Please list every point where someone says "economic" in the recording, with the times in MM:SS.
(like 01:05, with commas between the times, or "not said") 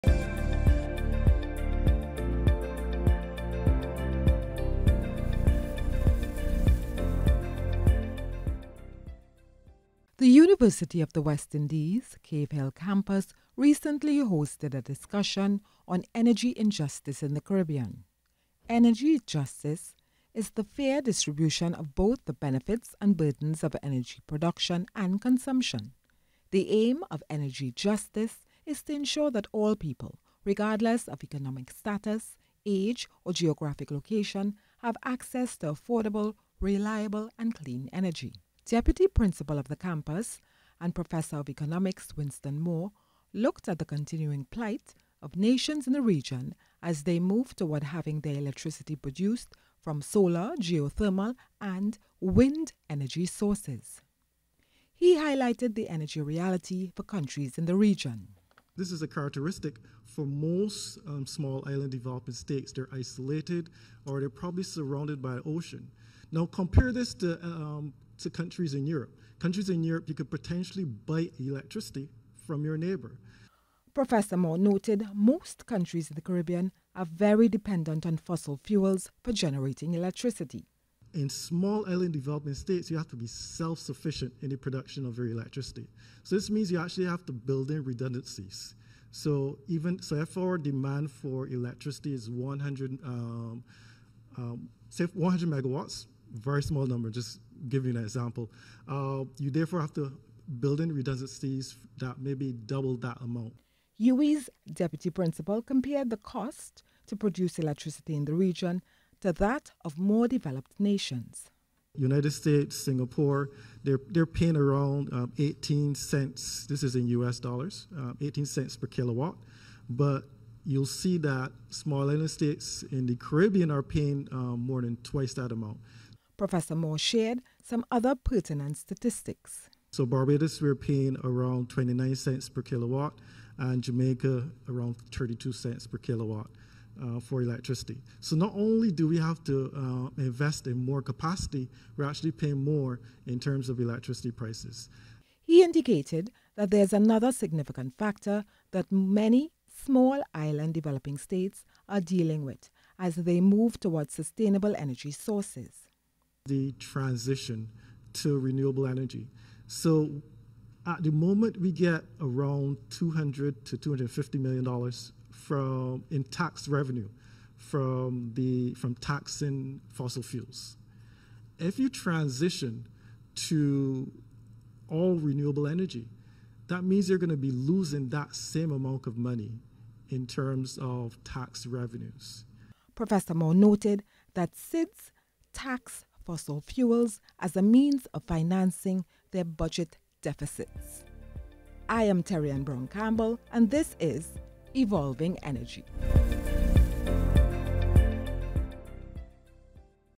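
00:31, 00:41.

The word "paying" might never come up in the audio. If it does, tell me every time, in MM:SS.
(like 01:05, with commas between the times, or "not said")
01:54, 02:03, 02:10, 02:22.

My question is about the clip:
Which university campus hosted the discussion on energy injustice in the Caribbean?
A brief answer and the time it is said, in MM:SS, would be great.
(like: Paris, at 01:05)
Cave Hill, at 00:12.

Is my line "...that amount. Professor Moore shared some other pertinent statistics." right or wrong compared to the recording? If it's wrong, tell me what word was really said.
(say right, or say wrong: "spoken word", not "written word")
right.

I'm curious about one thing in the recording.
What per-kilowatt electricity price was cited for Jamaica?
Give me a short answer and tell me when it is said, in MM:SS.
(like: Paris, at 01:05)
32 cents, at 02:15.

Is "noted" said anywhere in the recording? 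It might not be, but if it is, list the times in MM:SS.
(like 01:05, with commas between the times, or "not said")
01:14, 03:03.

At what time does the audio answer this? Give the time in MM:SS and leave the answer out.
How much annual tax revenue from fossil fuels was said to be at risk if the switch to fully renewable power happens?
02:42.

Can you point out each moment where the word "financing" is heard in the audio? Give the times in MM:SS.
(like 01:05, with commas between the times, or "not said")
03:08.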